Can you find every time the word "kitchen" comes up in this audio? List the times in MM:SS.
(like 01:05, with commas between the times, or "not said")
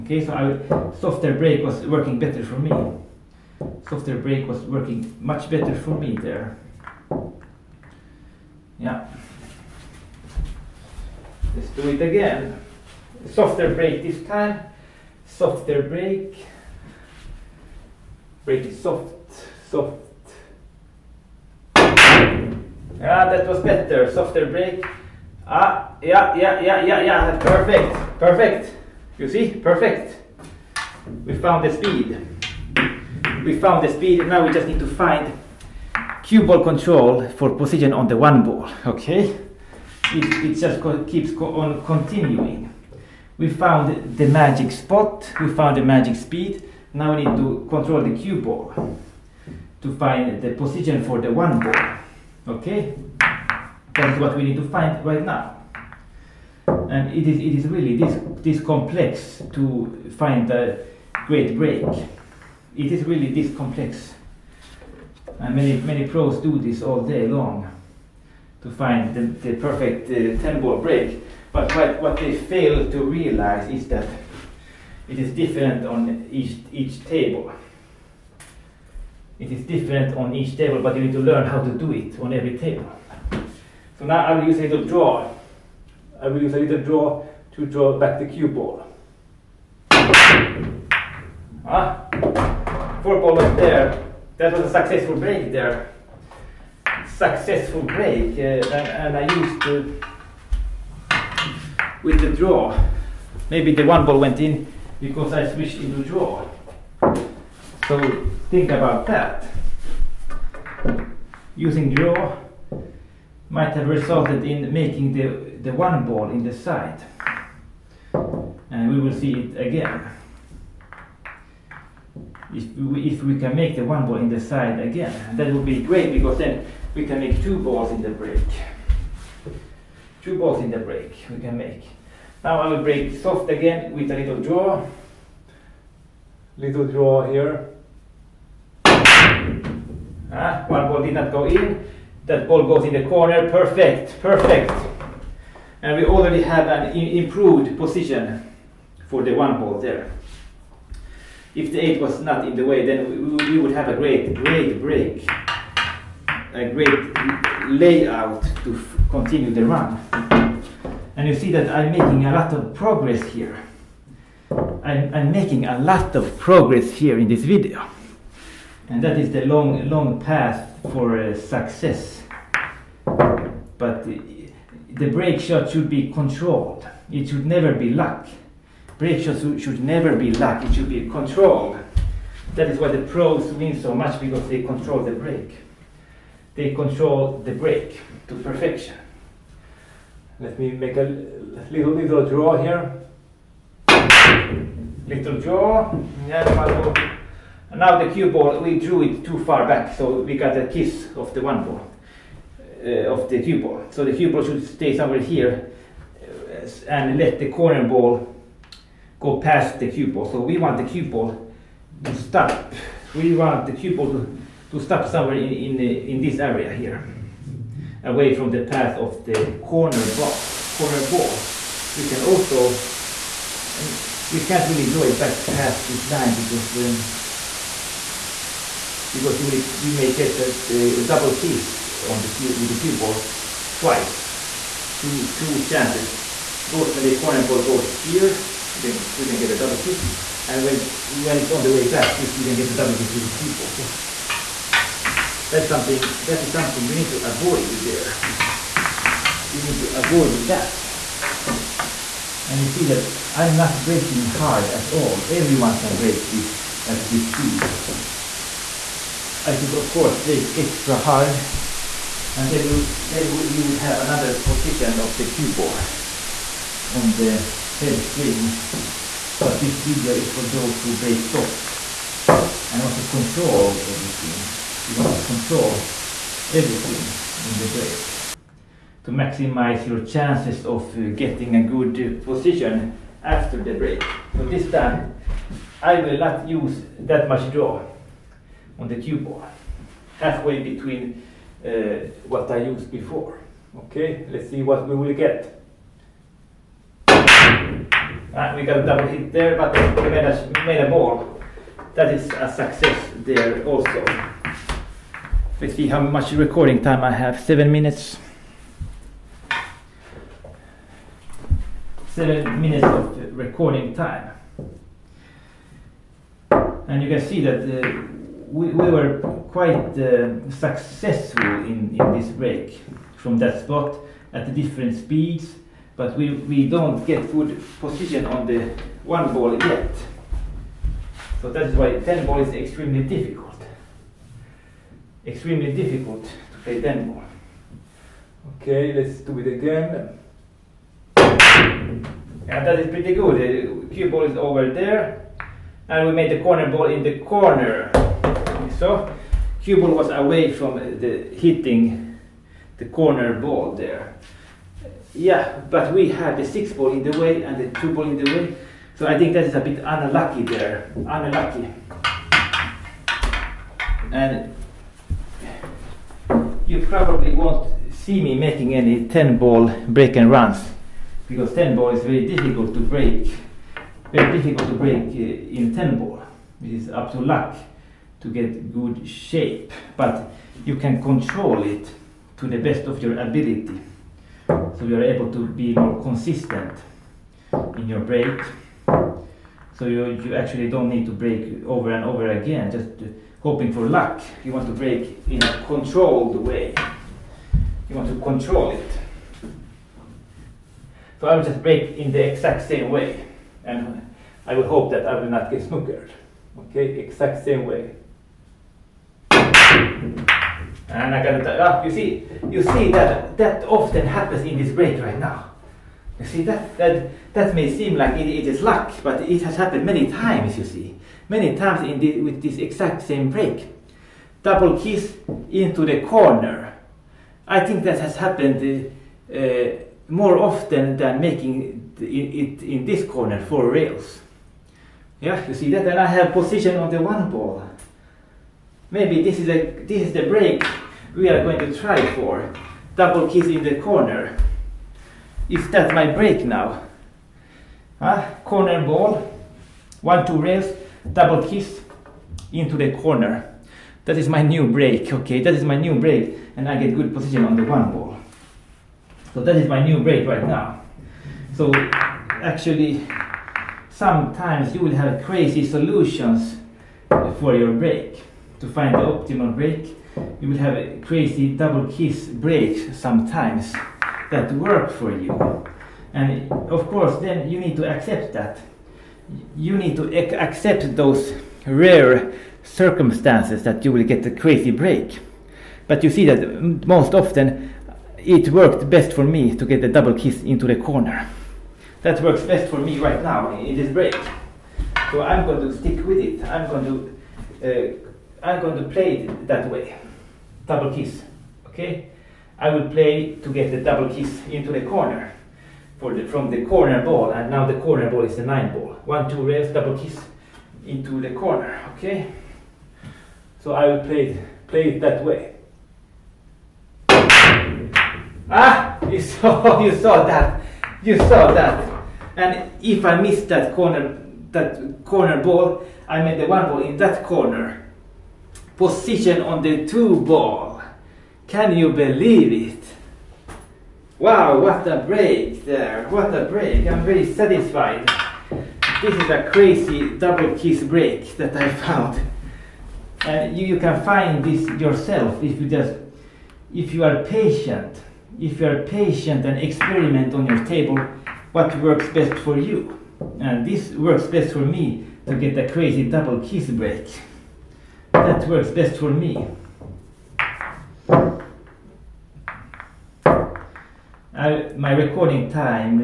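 not said.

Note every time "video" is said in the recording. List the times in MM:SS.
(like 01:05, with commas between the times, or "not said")
02:47, 04:29.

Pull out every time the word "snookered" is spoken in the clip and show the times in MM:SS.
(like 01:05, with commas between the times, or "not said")
06:45.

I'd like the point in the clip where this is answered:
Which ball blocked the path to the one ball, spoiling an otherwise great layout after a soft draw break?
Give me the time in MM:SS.
02:31.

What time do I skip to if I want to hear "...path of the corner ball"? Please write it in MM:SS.
03:38.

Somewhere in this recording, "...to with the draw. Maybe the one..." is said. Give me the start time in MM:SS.
01:39.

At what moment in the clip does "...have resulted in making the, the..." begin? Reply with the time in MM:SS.
01:53.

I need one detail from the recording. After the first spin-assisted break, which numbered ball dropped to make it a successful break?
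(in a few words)
four ball.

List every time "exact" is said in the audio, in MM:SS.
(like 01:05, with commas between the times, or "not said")
06:42, 06:46, 07:02.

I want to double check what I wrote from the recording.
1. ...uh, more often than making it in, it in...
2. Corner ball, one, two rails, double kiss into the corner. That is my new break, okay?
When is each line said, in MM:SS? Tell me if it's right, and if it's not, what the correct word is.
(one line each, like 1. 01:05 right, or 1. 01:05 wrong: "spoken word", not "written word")
1. 07:09 right
2. 07:28 right.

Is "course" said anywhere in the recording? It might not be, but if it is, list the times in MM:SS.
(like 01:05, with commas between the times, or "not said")
04:19, 07:56.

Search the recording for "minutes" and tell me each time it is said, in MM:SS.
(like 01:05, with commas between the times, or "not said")
05:07, 05:12.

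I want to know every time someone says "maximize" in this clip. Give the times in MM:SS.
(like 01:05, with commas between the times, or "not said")
04:39.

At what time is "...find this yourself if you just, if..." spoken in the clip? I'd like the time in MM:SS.
09:04.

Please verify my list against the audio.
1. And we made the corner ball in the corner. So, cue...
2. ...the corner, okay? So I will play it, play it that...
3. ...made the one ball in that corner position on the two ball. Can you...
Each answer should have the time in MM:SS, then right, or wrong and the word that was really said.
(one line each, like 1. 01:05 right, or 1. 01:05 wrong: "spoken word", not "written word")
1. 05:45 right
2. 08:31 right
3. 08:46 right.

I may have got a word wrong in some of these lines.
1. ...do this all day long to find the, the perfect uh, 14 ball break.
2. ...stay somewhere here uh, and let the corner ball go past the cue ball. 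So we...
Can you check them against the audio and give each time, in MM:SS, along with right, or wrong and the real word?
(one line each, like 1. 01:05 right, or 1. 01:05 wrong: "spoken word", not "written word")
1. 01:06 wrong: "10", not "14"
2. 03:24 right.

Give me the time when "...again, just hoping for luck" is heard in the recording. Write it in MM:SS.
06:32.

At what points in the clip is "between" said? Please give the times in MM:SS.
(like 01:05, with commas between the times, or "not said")
04:50.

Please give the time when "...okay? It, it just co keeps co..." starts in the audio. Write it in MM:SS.
00:38.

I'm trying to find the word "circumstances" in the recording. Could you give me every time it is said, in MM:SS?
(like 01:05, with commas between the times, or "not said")
08:02.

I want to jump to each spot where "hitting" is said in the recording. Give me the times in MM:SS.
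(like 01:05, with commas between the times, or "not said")
05:51.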